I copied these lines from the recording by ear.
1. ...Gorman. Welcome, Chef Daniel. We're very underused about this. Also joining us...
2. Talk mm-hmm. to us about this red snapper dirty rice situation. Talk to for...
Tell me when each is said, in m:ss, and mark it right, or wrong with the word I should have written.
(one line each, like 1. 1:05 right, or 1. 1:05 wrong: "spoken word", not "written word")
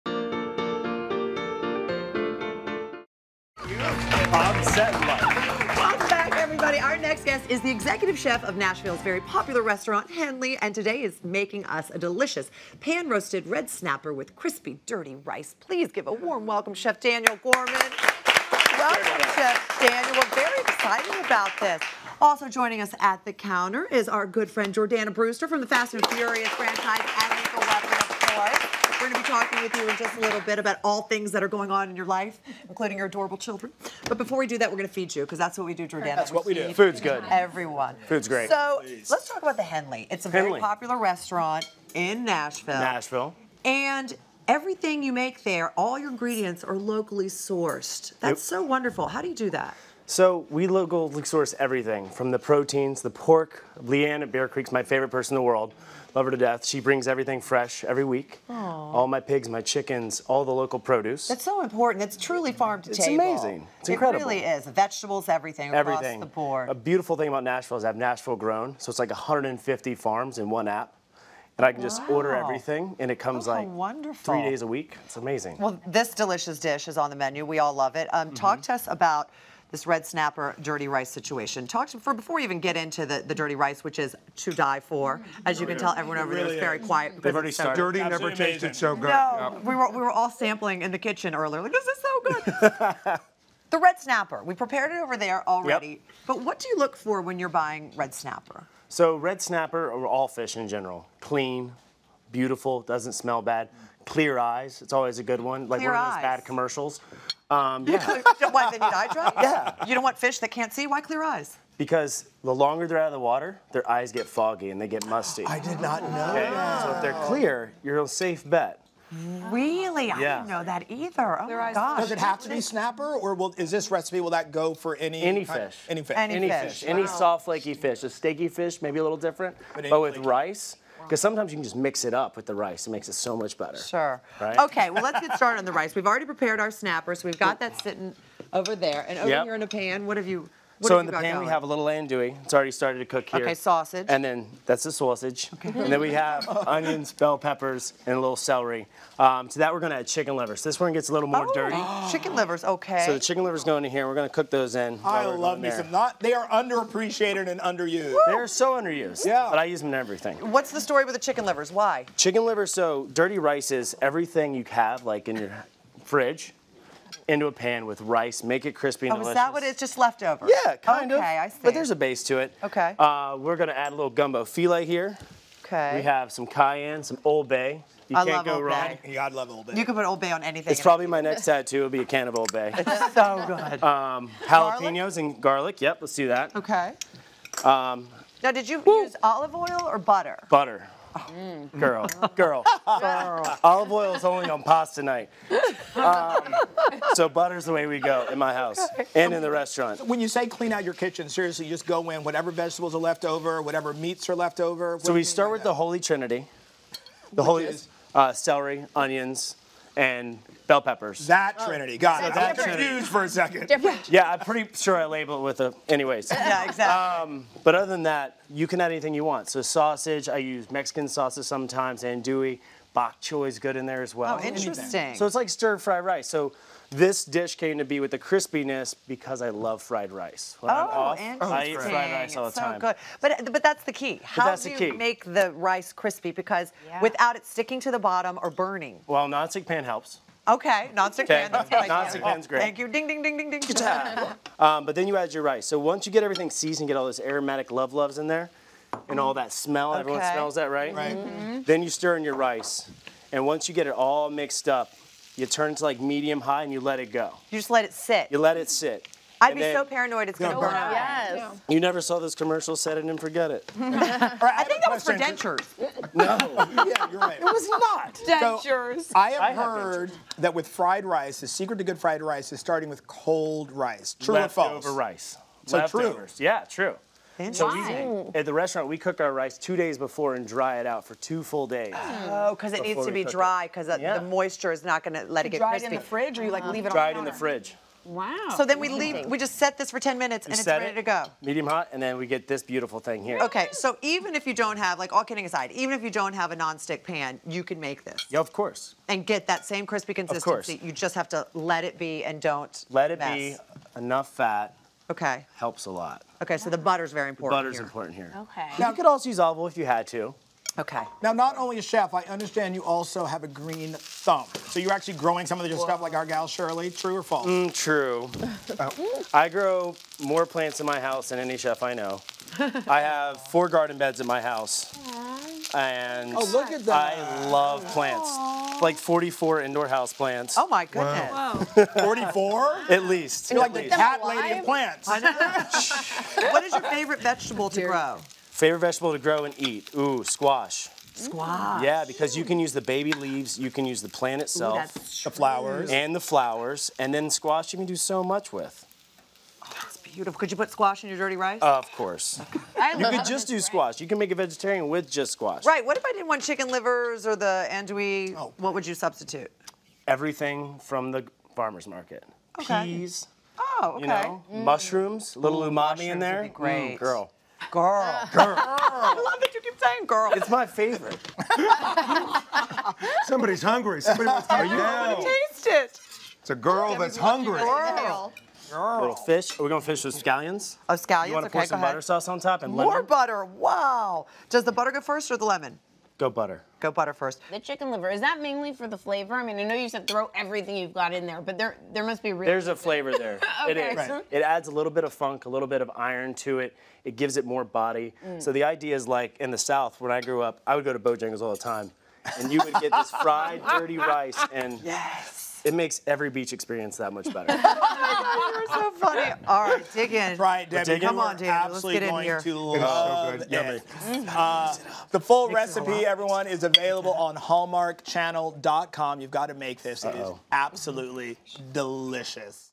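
1. 0:17 wrong: "excited", not "underused"
2. 1:18 right.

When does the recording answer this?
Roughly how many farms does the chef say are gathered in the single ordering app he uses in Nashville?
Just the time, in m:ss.
1:09.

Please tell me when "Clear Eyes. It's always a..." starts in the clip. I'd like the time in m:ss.
1:44.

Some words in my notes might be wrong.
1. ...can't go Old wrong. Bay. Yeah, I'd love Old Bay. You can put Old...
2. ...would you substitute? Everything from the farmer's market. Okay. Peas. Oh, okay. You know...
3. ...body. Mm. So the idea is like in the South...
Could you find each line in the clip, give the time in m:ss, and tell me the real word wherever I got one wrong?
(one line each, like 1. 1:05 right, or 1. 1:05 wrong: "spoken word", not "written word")
1. 2:58 right
2. 5:58 right
3. 6:37 right.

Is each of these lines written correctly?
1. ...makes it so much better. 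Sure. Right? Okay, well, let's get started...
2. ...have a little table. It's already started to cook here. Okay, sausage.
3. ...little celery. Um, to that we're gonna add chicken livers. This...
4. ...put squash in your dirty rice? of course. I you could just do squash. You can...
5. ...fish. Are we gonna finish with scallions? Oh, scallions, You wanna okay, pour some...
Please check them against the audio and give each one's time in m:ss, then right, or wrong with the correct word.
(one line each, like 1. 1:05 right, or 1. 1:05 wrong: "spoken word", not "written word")
1. 2:12 right
2. 2:21 wrong: "andouille", not "table"
3. 2:28 right
4. 5:50 right
5. 6:19 right.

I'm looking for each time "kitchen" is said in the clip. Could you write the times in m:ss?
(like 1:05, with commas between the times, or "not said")
1:30, 3:20.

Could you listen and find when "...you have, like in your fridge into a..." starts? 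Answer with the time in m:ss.
2:44.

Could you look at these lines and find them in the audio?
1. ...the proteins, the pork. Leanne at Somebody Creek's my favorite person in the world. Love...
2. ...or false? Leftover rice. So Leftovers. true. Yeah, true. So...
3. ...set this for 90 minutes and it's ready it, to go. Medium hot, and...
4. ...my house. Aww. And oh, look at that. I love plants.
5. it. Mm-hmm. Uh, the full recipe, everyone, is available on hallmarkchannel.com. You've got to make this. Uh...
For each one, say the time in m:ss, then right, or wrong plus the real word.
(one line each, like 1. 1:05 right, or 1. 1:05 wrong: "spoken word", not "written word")
1. 0:52 wrong: "Bear", not "Somebody"
2. 4:34 right
3. 4:49 wrong: "10", not "90"
4. 5:24 right
5. 6:53 right.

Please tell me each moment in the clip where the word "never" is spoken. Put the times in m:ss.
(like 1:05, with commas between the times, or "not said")
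1:28, 4:21.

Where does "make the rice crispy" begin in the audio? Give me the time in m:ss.
3:54.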